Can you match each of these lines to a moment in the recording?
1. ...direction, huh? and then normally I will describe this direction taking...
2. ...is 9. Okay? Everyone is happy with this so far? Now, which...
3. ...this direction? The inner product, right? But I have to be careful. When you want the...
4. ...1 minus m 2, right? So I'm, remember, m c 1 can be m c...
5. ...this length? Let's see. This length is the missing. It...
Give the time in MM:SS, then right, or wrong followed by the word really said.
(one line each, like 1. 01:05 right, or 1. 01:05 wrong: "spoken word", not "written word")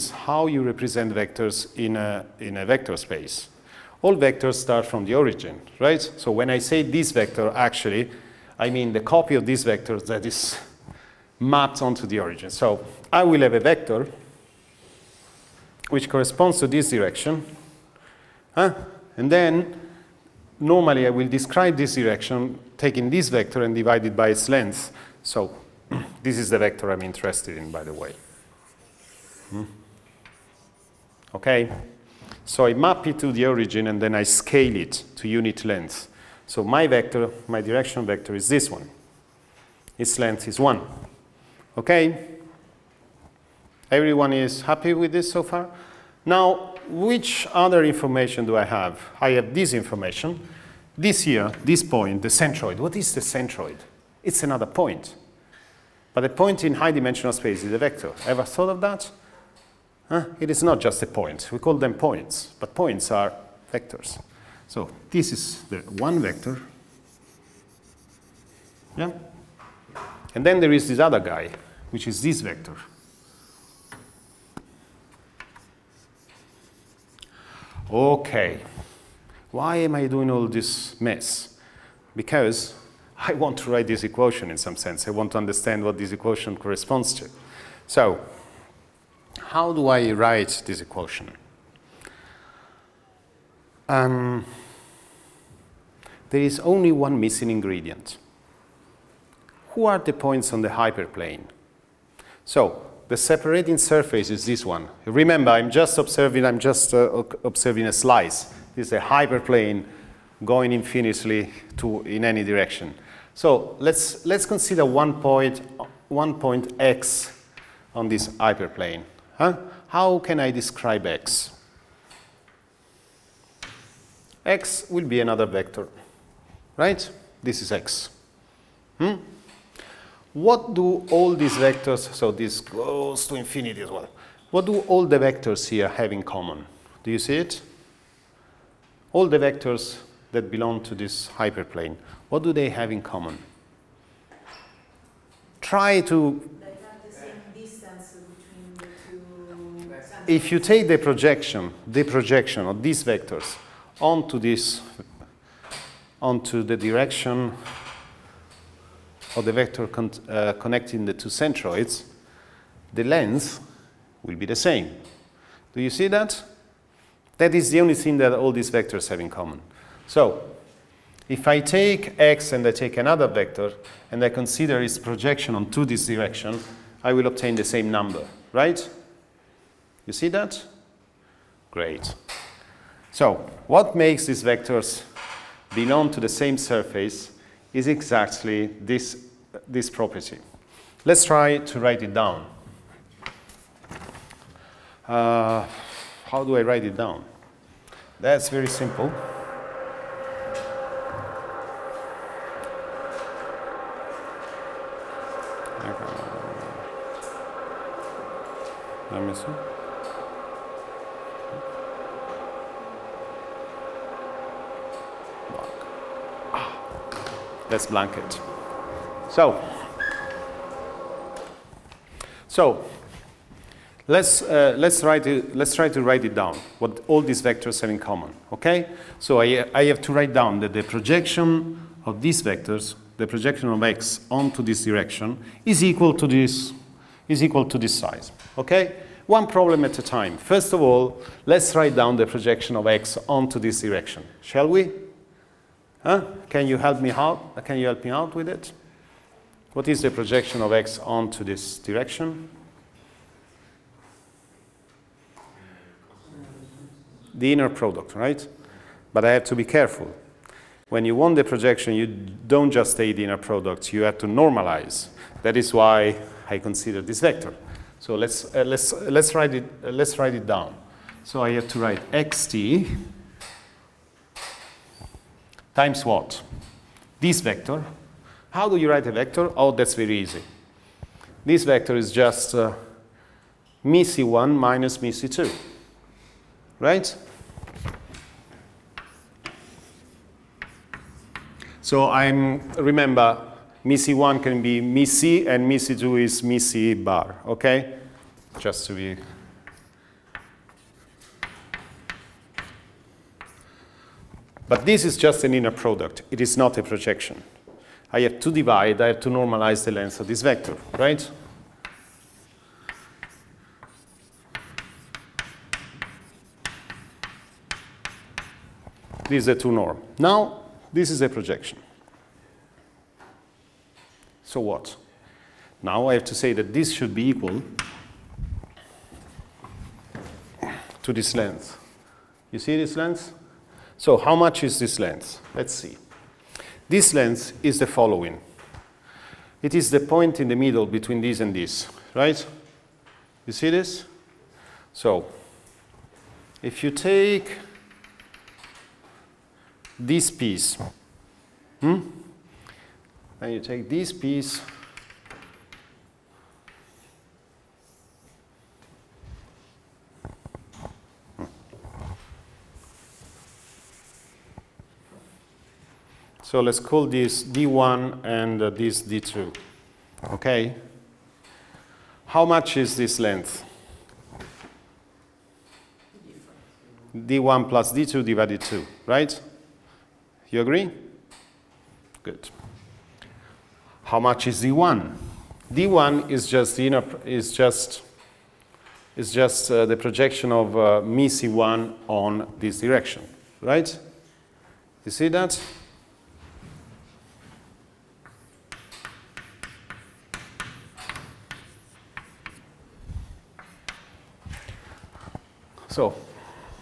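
1. 00:16 right
2. 00:40 wrong: "1", not "9"
3. 04:11 right
4. 04:43 right
5. 05:34 wrong: "following", not "missing".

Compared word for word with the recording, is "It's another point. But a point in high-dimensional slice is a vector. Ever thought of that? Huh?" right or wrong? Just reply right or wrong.
wrong.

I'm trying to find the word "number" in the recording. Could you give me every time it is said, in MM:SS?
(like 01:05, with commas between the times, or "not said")
02:57.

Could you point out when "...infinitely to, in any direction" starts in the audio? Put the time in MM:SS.
01:50.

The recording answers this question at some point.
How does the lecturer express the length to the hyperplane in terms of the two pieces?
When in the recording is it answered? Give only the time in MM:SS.
06:17.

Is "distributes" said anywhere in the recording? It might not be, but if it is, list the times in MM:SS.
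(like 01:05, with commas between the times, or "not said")
not said.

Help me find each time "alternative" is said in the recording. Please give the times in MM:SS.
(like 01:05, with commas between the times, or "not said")
not said.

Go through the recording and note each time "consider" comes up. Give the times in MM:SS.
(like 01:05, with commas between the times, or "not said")
01:54, 02:54, 04:26.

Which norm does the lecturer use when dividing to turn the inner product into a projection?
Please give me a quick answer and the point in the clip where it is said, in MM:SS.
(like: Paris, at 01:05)
two norm, at 05:19.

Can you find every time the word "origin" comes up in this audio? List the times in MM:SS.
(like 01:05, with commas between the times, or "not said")
00:05, 00:12, 00:33.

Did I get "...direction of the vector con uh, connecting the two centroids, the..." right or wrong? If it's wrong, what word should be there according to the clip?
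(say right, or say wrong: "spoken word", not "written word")
right.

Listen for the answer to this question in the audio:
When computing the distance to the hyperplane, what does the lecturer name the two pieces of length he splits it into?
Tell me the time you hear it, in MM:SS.
06:07.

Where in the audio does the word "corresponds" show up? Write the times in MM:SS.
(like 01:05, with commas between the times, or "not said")
00:16, 01:26.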